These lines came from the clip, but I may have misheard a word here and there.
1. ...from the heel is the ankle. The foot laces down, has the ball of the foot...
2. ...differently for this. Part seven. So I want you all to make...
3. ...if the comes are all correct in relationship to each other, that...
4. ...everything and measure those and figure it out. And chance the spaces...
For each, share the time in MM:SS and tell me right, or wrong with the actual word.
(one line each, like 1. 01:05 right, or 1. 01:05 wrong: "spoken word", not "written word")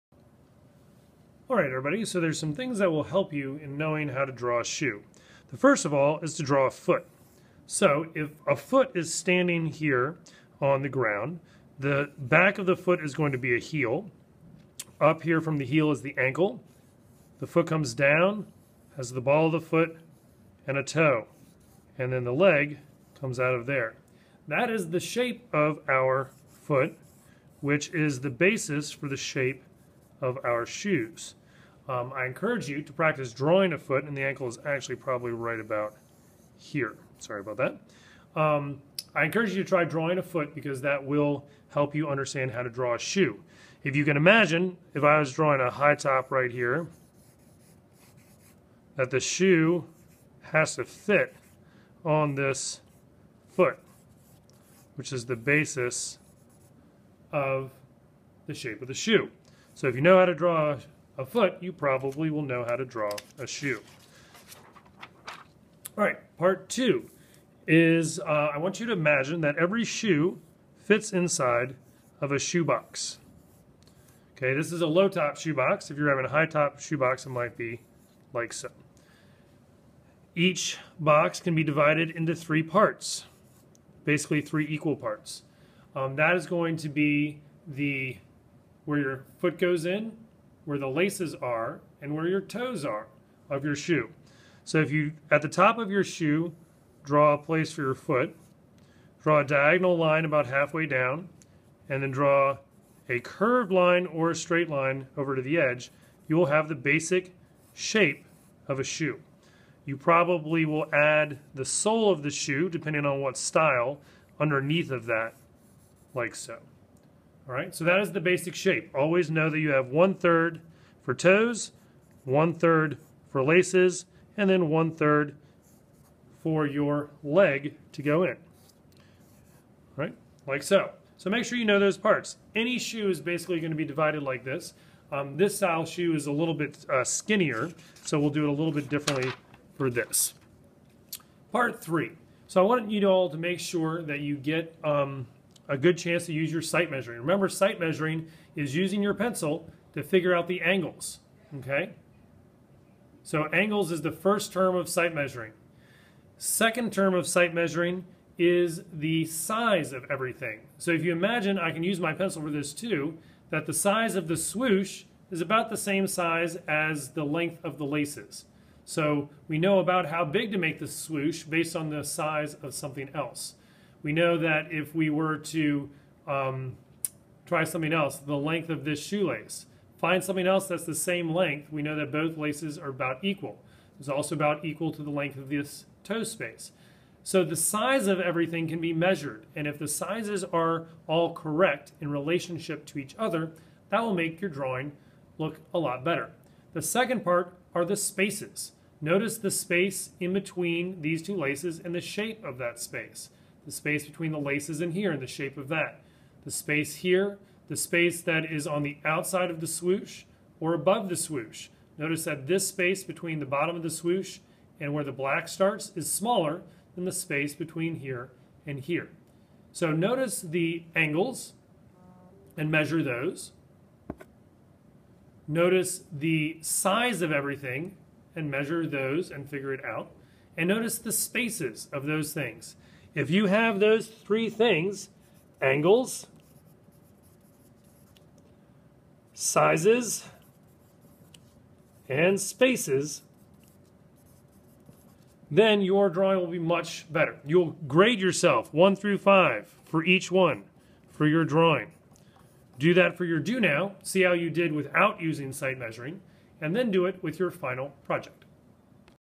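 1. 00:15 wrong: "comes", not "laces"
2. 02:18 wrong: "three", not "seven"
3. 03:09 wrong: "sizes", not "comes"
4. 03:47 wrong: "notice", not "chance".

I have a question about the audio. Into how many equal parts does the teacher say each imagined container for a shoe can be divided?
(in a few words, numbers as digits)
3.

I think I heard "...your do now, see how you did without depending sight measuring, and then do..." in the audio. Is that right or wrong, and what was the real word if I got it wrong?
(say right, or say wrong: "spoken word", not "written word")
wrong: "using", not "depending".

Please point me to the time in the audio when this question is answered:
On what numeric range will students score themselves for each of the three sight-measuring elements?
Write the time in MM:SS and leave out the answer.
04:08.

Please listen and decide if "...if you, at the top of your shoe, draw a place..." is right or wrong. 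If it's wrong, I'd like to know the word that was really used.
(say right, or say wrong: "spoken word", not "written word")
right.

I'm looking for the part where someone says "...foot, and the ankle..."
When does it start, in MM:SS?
00:33.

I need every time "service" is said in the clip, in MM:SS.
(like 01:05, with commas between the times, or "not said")
not said.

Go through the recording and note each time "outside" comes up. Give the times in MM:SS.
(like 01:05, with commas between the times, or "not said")
03:29.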